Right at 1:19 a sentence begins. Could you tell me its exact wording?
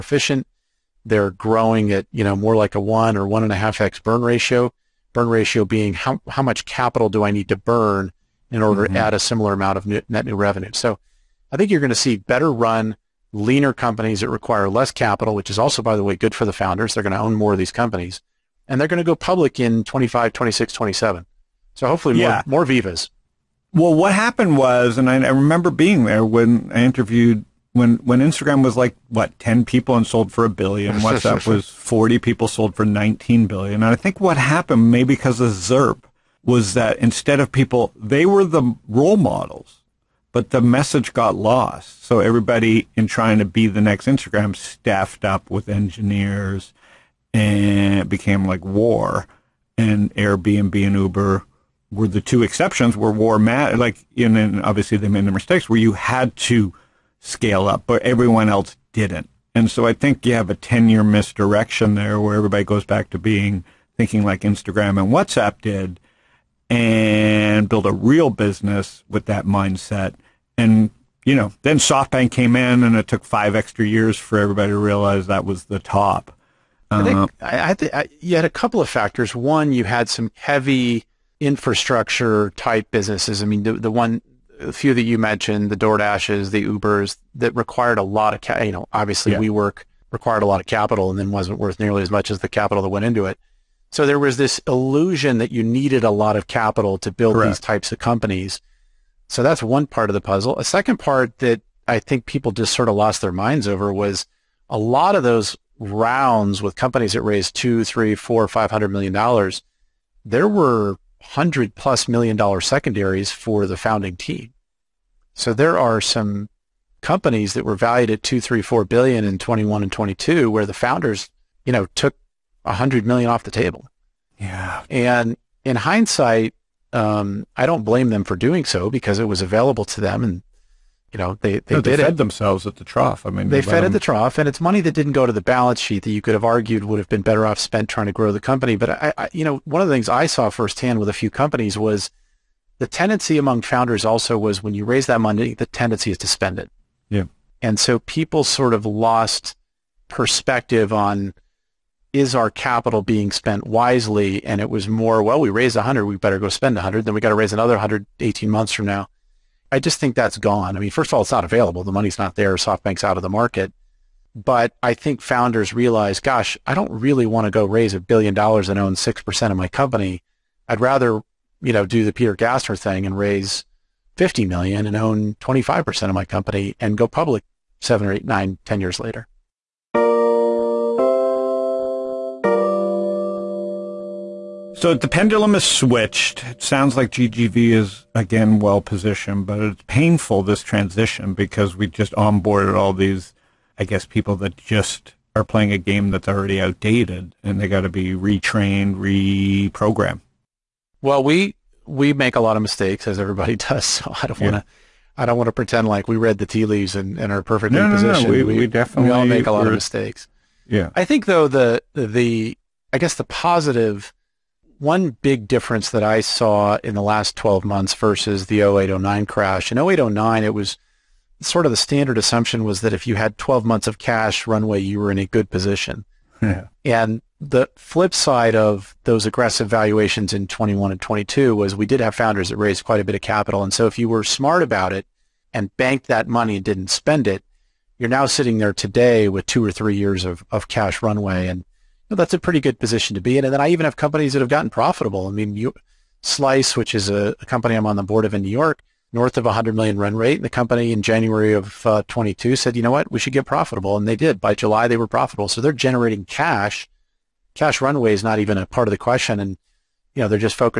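One, you had some heavy infrastructure type businesses.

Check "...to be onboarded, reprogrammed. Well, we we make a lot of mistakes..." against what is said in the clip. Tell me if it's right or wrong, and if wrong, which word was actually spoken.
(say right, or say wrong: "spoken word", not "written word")
wrong: "retrained", not "onboarded".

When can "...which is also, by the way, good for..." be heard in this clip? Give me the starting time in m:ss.
0:15.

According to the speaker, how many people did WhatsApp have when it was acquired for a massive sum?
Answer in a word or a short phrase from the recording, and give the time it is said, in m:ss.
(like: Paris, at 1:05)
40, at 0:31.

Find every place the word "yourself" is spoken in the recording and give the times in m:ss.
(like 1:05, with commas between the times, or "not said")
not said.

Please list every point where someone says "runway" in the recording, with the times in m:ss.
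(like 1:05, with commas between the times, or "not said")
3:44, 4:01, 4:17.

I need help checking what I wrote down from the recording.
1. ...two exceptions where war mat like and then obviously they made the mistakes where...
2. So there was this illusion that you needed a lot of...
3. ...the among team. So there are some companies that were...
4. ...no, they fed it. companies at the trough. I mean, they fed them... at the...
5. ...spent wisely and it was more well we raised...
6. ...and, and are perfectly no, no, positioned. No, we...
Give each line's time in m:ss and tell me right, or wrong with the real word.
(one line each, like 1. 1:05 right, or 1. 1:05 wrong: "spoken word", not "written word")
1. 0:52 right
2. 1:33 right
3. 1:53 wrong: "founding", not "among"
4. 2:11 wrong: "themselves", not "companies"
5. 2:33 right
6. 3:26 right.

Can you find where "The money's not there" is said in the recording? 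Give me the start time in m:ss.
2:41.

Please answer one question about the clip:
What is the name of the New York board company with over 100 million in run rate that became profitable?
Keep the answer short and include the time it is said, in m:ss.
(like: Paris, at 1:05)
Slice, at 4:06.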